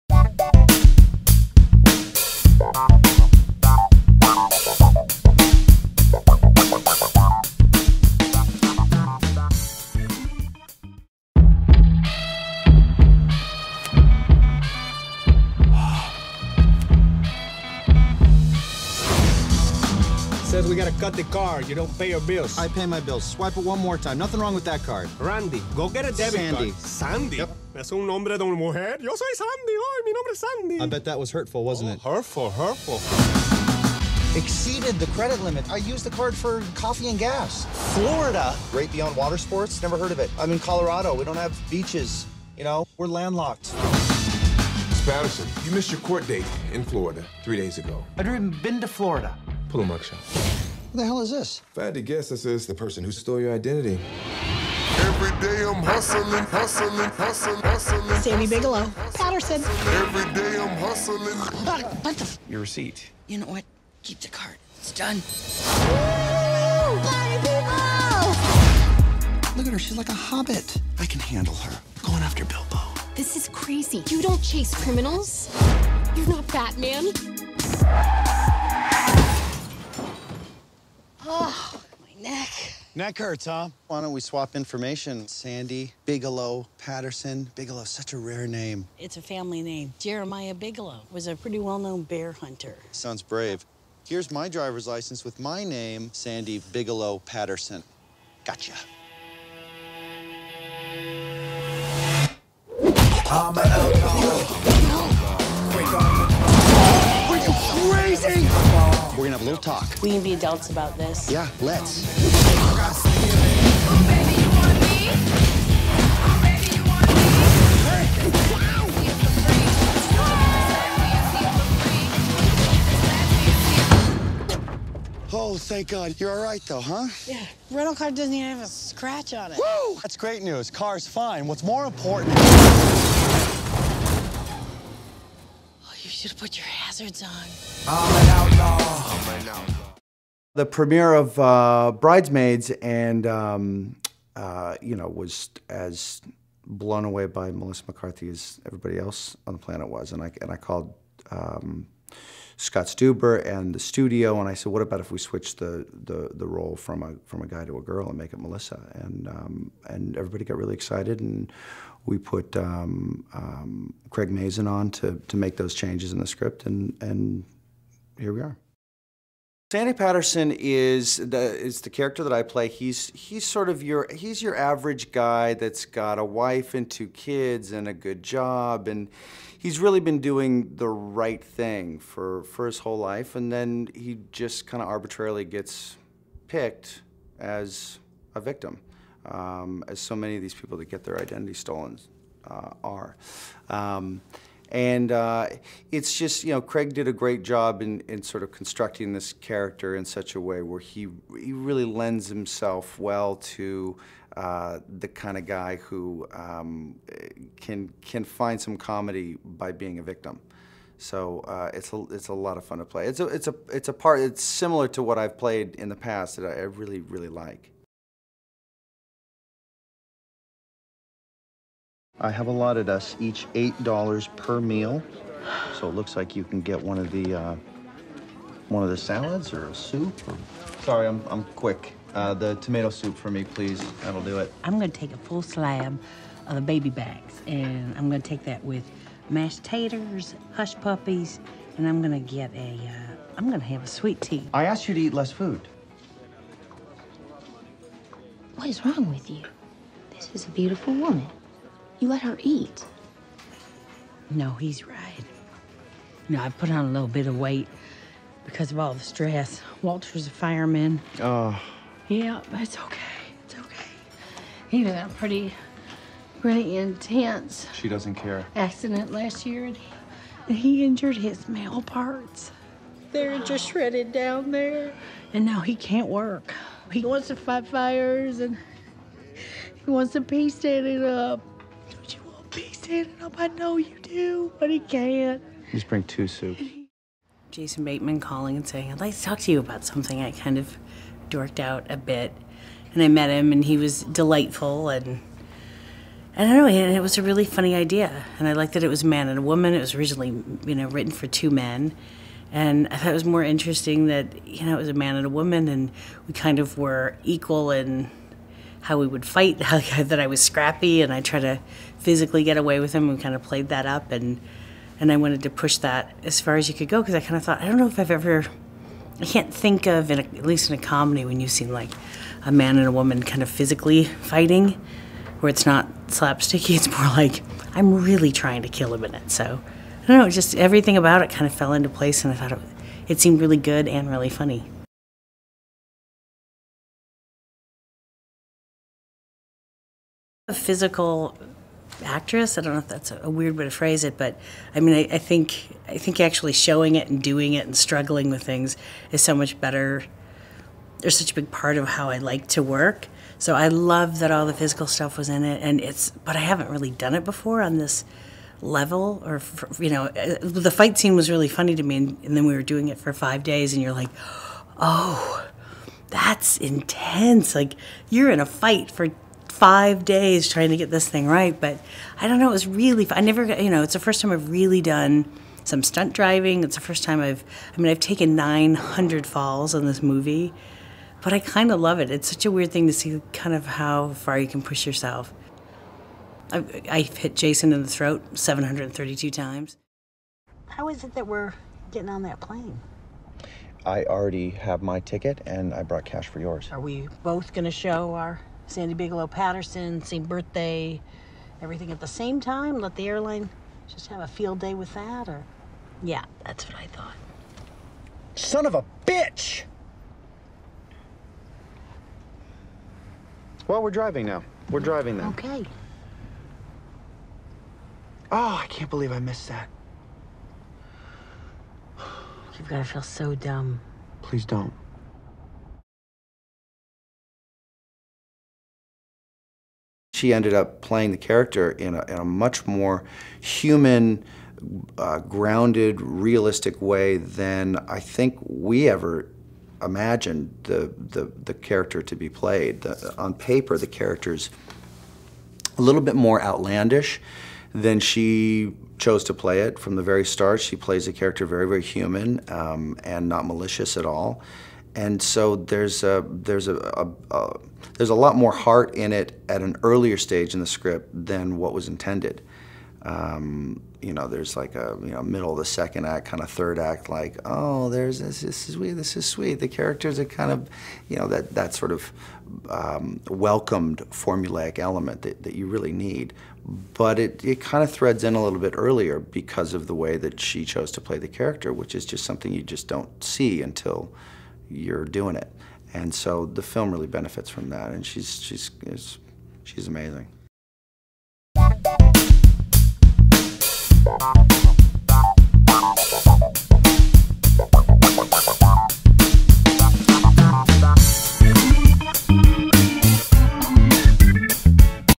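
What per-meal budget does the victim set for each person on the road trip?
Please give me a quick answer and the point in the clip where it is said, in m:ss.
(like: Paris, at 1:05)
$8, at 3:43.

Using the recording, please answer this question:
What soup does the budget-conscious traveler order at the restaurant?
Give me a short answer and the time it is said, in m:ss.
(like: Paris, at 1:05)
Tomato soup, at 3:52.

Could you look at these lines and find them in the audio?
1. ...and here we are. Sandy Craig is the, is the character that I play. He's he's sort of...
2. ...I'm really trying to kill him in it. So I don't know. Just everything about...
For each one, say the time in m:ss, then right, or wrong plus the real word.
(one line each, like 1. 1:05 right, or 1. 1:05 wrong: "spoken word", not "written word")
1. 2:47 wrong: "Patterson", not "Craig"
2. 5:27 right.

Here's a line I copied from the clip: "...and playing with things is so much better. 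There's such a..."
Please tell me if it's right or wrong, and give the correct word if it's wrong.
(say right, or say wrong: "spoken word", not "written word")
wrong: "struggling", not "playing".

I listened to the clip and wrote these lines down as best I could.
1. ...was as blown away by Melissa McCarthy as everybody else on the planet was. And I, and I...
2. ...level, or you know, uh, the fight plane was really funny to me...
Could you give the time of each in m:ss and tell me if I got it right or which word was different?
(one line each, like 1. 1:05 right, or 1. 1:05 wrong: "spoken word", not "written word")
1. 2:25 right
2. 5:58 wrong: "scene", not "plane".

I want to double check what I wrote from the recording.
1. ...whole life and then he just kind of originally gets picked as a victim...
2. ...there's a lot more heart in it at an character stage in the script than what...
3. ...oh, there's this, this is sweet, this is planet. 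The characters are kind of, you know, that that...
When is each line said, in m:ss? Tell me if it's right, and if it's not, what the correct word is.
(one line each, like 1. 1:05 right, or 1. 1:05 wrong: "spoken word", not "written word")
1. 3:02 wrong: "arbitrarily", not "originally"
2. 7:37 wrong: "earlier", not "character"
3. 7:47 wrong: "sweet", not "planet".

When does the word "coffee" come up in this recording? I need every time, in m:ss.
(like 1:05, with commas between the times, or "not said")
0:36.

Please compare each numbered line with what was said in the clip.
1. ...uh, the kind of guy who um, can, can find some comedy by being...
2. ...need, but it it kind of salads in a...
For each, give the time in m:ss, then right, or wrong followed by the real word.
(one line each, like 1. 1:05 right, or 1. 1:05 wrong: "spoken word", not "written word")
1. 3:24 right
2. 7:55 wrong: "threads", not "salads".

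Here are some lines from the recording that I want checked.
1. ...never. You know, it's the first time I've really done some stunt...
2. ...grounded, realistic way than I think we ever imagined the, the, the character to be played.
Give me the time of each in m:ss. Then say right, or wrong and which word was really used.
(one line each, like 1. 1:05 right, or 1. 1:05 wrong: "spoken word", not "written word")
1. 6:13 right
2. 7:15 right.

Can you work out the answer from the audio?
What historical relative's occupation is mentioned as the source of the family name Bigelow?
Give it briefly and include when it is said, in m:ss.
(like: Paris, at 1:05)
Bear hunter, at 1:32.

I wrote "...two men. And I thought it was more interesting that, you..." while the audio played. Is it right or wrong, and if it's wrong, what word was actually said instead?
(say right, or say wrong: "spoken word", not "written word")
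right.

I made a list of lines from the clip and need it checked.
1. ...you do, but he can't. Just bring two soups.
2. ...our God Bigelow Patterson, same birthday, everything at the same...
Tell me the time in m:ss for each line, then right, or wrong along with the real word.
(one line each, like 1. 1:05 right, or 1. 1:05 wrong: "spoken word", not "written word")
1. 4:43 right
2. 6:38 wrong: "Sandy", not "God".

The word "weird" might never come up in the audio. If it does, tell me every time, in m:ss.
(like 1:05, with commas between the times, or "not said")
5:43, 6:22.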